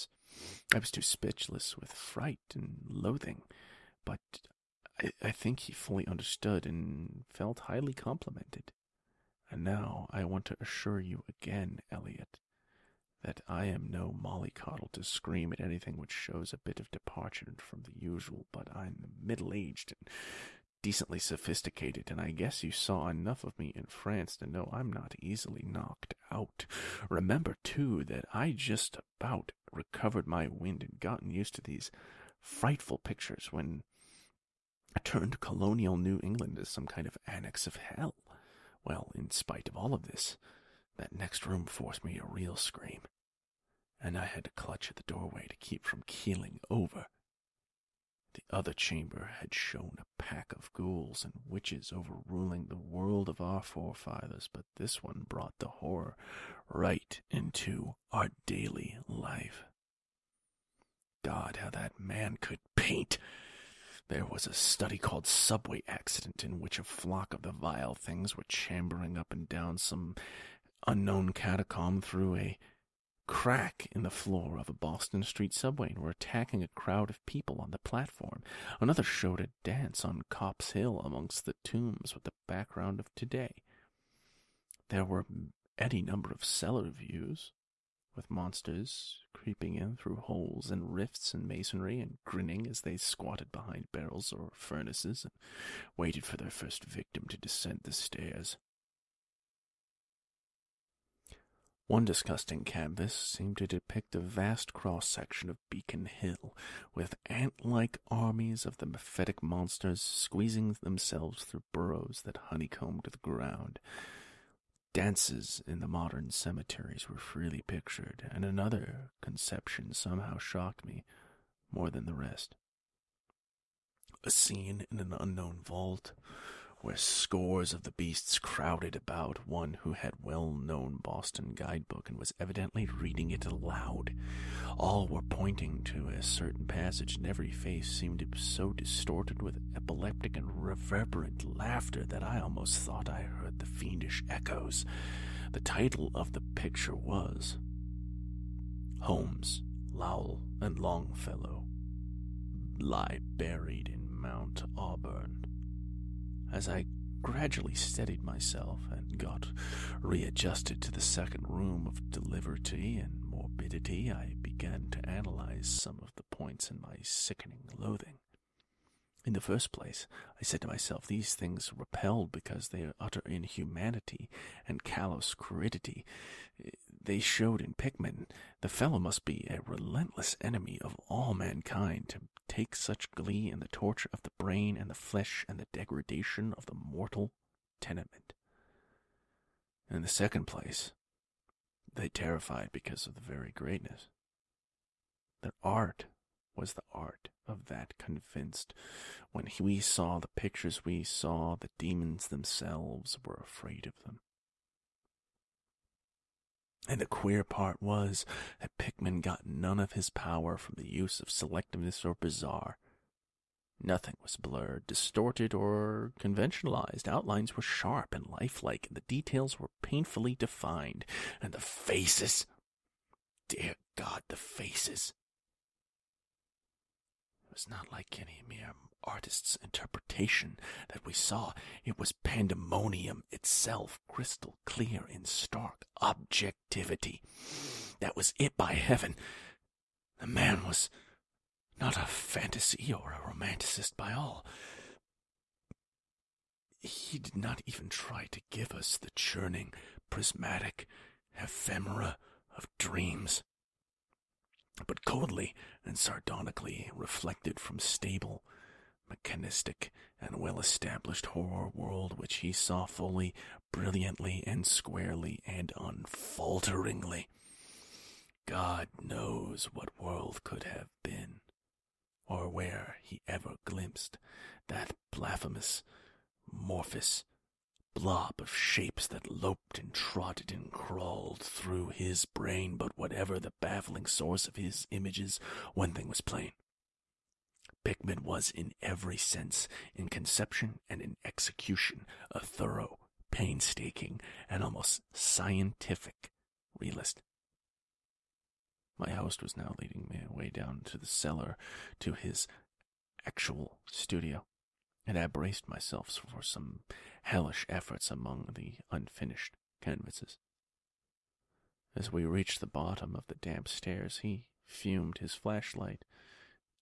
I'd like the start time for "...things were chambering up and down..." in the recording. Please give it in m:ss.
1:07.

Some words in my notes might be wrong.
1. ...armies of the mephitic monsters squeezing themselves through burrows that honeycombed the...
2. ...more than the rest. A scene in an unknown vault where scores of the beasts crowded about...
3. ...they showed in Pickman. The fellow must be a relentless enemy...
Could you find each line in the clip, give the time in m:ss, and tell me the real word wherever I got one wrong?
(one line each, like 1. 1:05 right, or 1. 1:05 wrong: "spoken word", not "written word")
1. 1:48 right
2. 2:01 right
3. 2:57 right.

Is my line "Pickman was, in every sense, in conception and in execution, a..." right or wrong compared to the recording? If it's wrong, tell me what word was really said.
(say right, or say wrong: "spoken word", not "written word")
right.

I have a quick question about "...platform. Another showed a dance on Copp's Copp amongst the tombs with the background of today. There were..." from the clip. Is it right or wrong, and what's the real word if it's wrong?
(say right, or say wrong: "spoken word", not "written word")
wrong: "Hill", not "Copp".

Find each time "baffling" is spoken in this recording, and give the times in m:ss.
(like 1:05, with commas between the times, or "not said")
4:43.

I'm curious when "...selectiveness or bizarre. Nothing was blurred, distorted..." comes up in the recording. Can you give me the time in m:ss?
3:31.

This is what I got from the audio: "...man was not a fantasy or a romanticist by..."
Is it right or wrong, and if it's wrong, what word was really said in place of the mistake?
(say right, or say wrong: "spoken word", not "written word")
right.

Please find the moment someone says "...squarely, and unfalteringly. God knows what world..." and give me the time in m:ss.
4:24.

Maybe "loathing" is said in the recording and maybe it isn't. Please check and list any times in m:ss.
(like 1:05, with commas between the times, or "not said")
0:02, 2:47.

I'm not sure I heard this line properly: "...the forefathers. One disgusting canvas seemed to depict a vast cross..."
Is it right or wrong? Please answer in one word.
wrong.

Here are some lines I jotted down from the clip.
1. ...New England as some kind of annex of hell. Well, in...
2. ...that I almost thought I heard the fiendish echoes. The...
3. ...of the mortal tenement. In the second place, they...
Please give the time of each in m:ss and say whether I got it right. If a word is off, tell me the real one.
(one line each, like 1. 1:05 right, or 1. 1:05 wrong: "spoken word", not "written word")
1. 0:35 right
2. 2:22 right
3. 3:06 right.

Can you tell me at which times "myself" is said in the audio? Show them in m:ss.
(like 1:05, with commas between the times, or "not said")
2:38, 2:50, 5:05.